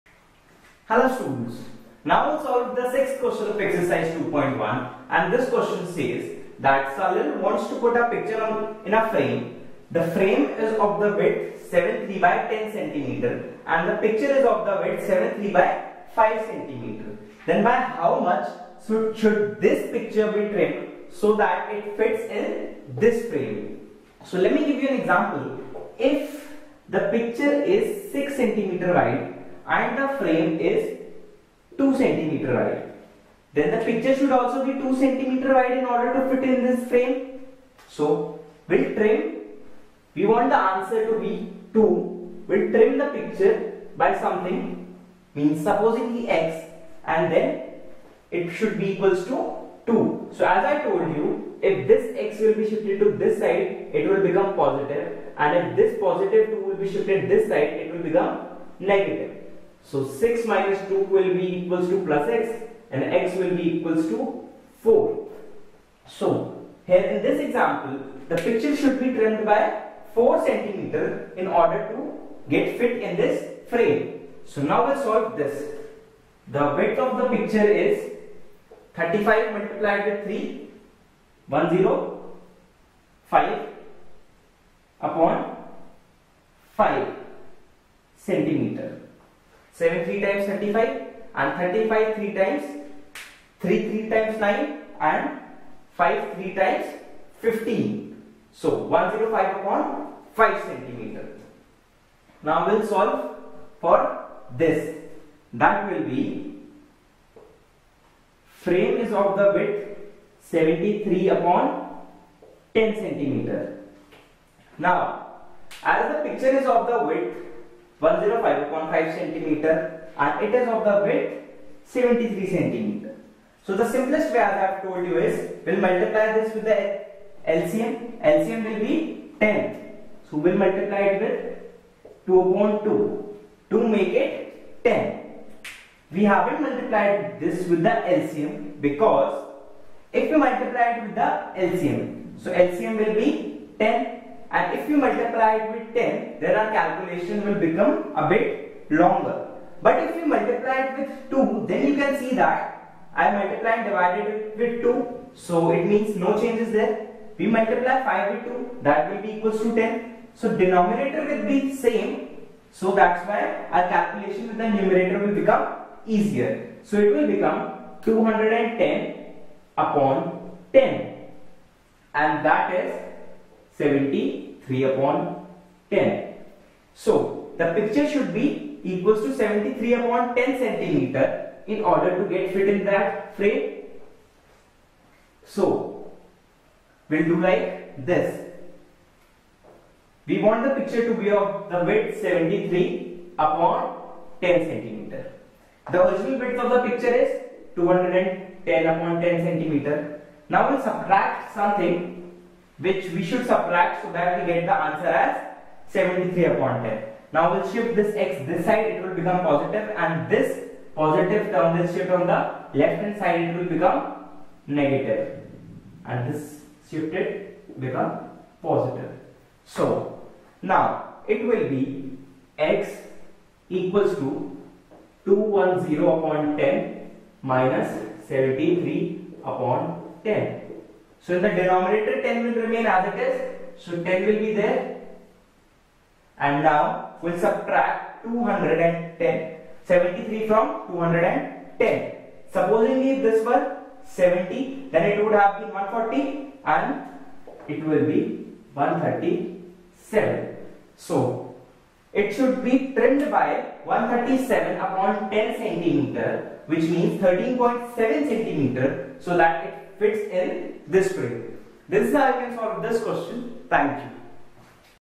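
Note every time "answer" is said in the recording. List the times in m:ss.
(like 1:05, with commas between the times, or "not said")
0:40, 3:24.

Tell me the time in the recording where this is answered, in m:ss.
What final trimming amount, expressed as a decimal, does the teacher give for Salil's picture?
4:17.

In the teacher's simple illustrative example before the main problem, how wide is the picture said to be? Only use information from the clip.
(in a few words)
6 centimeter.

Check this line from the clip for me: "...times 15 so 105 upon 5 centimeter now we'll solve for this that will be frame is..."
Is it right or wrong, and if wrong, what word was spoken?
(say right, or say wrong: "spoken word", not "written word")
right.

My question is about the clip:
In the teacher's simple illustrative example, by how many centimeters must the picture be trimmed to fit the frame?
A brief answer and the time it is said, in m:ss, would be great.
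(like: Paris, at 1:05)
4 centimeter, at 1:09.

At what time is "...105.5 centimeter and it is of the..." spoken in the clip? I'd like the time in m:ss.
1:58.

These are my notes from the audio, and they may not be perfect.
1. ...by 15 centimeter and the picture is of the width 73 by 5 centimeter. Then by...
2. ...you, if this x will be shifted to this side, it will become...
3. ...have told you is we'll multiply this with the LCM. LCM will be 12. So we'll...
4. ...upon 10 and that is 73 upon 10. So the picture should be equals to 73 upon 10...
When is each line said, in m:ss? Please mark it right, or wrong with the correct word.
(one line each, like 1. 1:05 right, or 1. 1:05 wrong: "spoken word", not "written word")
1. 0:12 wrong: "10", not "15"
2. 0:51 right
3. 2:04 wrong: "10", not "12"
4. 2:49 right.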